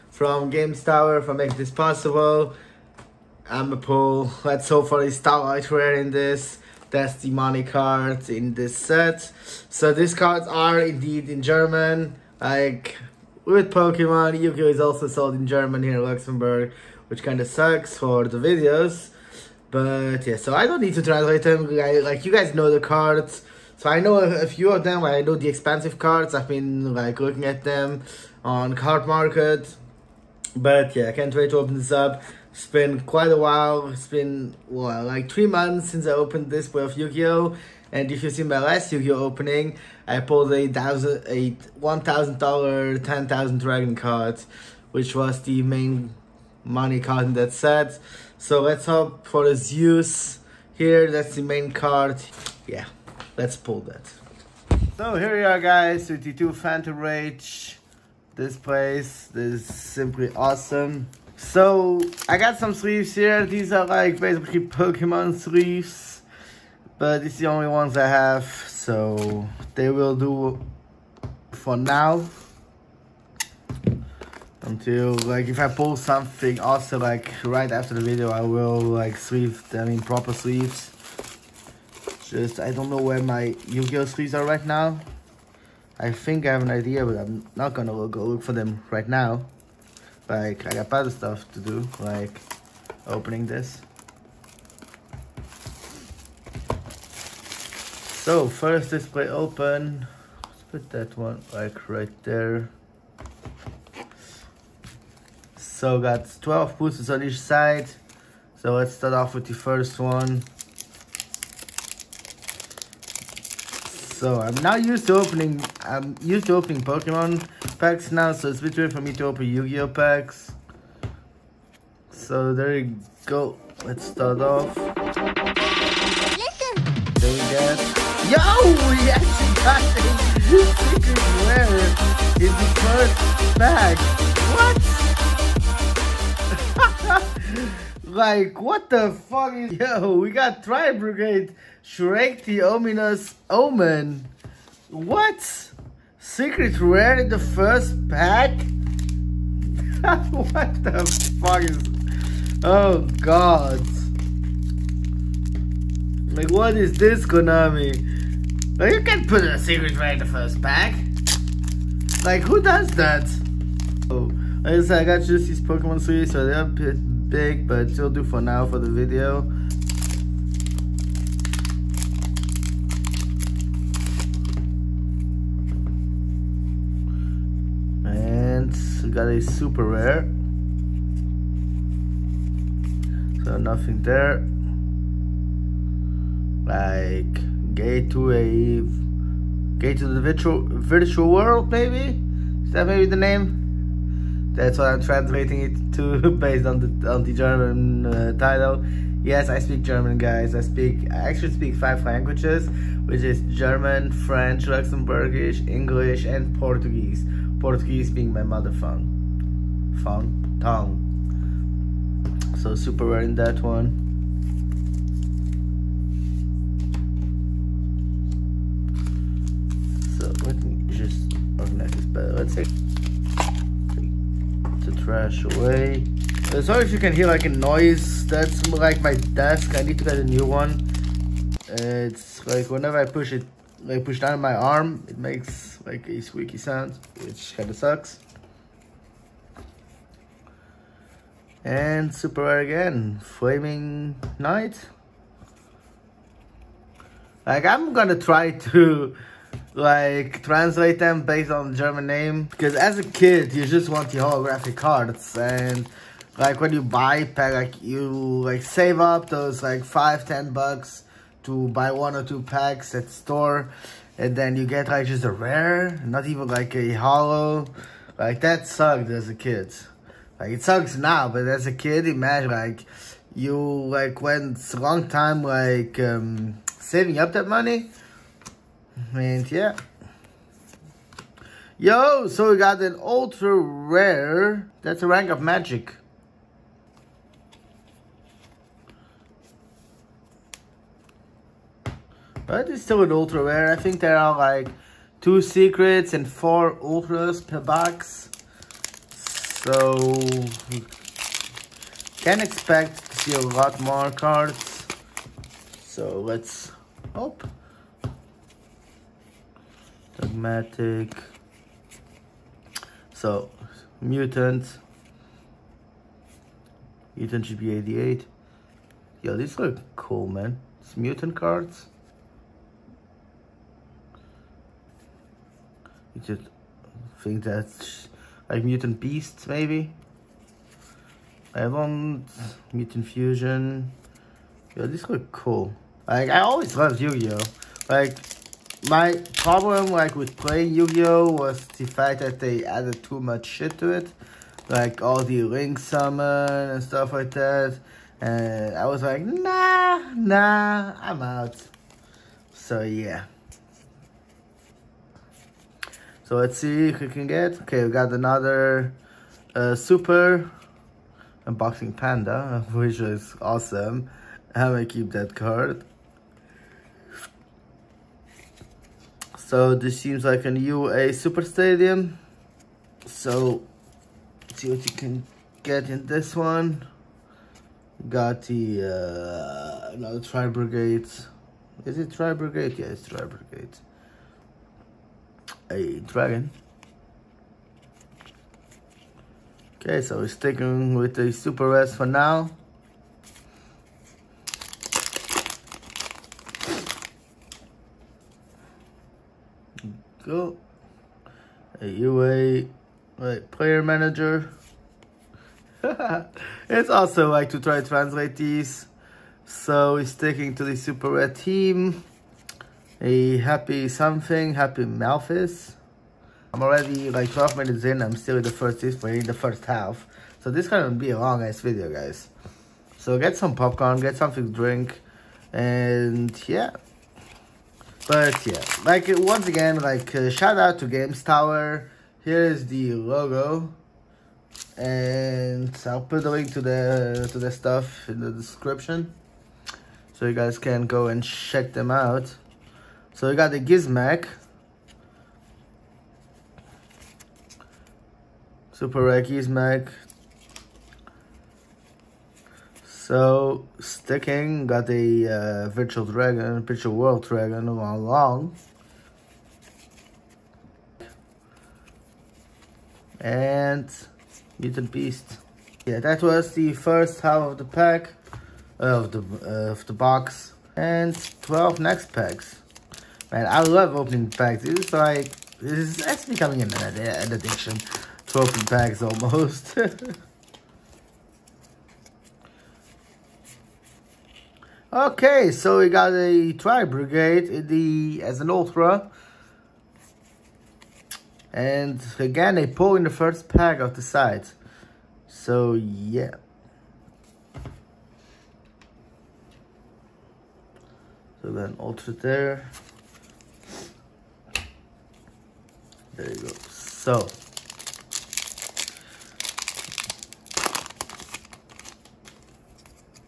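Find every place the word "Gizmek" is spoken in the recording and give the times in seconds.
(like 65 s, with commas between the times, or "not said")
443 s, 449 s.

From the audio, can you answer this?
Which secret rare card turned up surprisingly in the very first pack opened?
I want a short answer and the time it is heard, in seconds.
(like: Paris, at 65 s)
Tri Brigade, Shuraig the Ominous Omen, at 140 s.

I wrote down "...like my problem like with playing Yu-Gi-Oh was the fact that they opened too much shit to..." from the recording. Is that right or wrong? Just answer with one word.
wrong.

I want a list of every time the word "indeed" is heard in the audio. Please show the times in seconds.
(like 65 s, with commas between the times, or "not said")
10 s.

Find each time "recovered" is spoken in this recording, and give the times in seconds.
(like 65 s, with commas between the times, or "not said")
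not said.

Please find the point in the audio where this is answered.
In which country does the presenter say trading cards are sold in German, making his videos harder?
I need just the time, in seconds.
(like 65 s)
16 s.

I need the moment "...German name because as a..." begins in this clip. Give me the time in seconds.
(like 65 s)
251 s.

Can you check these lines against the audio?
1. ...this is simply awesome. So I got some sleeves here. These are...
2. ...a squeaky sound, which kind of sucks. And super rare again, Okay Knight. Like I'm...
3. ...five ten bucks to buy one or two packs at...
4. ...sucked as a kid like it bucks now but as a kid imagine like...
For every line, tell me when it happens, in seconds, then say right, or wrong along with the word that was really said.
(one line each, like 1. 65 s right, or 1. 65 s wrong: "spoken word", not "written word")
1. 59 s right
2. 236 s wrong: "Flaming", not "Okay"
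3. 259 s right
4. 268 s wrong: "sucks", not "bucks".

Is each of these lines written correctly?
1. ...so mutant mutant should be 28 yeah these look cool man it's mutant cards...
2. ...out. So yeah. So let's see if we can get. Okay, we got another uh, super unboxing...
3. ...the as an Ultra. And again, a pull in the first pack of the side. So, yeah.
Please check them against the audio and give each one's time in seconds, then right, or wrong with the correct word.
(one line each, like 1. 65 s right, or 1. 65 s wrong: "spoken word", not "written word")
1. 313 s wrong: "88", not "28"
2. 351 s right
3. 487 s right.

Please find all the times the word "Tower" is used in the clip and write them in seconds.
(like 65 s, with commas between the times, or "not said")
0 s, 431 s.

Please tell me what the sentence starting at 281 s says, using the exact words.
Yo, so we got an ultra rare.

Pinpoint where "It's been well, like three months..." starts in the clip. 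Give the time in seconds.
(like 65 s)
33 s.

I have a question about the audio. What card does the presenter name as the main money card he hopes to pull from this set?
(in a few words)
Zeus.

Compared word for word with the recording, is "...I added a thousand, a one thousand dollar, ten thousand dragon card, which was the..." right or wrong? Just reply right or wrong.
wrong.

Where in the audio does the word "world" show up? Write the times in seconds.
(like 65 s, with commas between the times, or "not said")
191 s, 456 s.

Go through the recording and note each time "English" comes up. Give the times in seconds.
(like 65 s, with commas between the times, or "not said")
205 s.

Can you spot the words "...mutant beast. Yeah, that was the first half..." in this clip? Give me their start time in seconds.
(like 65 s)
464 s.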